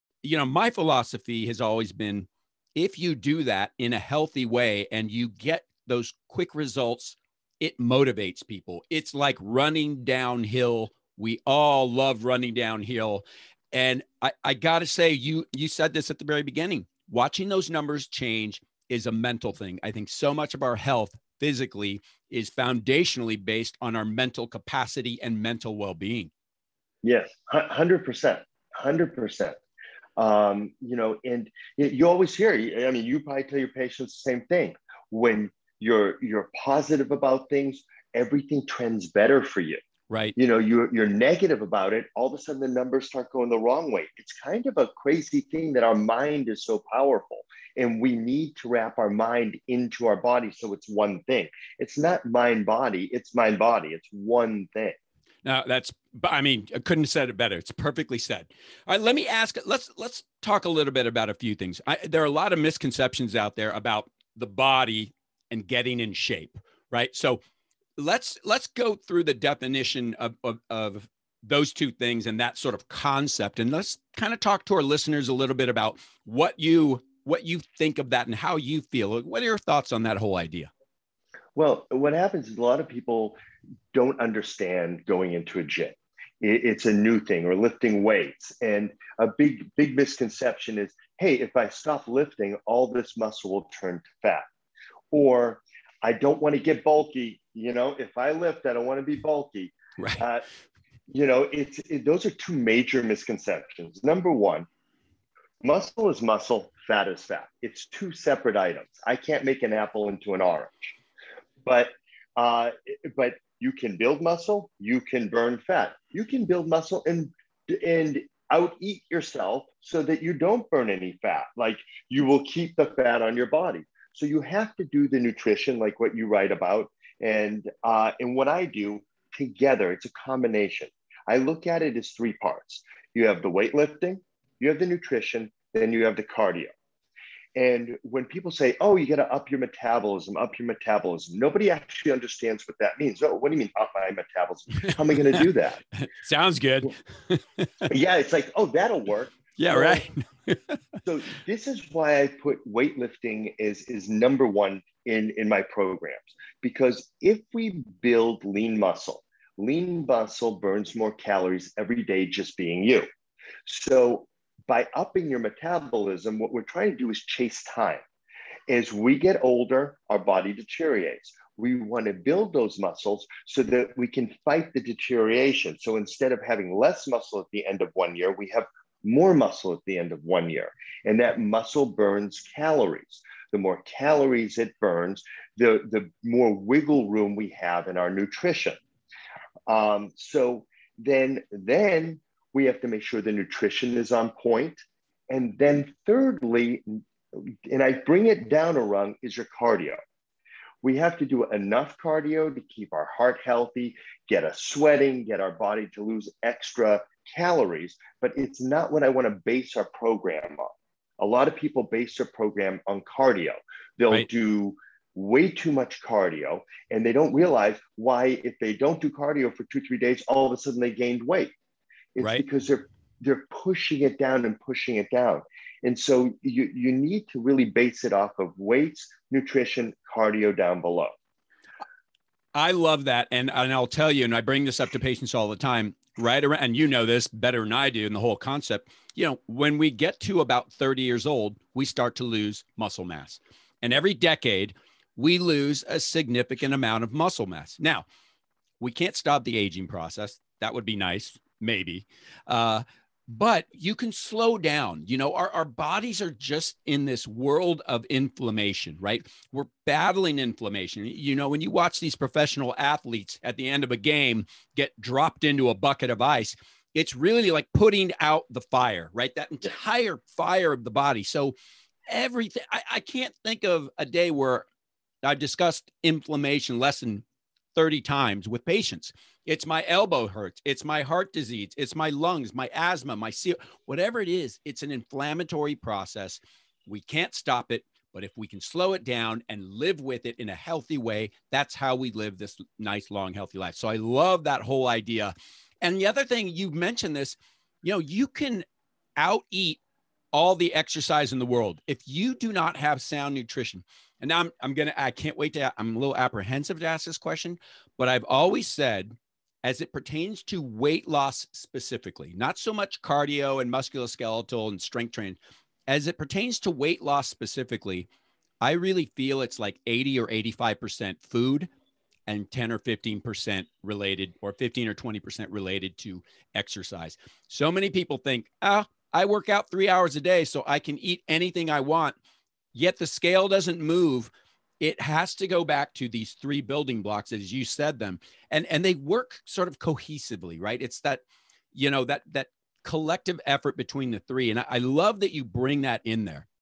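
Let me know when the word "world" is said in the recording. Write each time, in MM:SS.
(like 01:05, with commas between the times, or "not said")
04:17, 05:01.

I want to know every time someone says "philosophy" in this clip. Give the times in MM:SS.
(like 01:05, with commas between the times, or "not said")
00:00.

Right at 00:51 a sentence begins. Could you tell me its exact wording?
It's not mind body, it's mind body, it's one thing.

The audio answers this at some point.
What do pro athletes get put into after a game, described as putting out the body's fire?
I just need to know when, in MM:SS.
04:25.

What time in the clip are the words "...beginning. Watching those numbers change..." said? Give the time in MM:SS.
00:16.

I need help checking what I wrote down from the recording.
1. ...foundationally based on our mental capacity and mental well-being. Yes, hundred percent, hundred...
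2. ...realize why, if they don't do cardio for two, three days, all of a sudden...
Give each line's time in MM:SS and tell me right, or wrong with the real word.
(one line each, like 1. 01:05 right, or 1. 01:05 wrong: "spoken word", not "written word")
1. 00:22 right
2. 03:37 right.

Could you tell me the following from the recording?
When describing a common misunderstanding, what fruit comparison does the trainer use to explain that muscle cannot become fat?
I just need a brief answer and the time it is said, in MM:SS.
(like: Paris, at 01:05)
An apple into an orange, at 01:49.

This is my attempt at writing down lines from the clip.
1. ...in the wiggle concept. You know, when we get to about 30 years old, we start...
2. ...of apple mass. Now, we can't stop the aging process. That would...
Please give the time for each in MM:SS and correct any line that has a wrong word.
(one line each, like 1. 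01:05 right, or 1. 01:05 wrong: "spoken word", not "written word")
1. 03:58 wrong: "whole", not "wiggle"
2. 04:07 wrong: "muscle", not "apple".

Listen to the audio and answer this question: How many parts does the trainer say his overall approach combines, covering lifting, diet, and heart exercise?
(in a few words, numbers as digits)
3.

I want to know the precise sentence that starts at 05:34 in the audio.
It has to go back to these three building blocks as you said them.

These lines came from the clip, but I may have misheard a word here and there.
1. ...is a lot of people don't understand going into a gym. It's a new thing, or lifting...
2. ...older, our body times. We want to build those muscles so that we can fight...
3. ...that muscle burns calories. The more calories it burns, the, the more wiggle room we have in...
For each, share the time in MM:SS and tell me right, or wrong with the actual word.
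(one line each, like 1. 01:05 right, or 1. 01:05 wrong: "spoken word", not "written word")
1. 01:22 right
2. 02:49 wrong: "deteriorates", not "times"
3. 03:01 right.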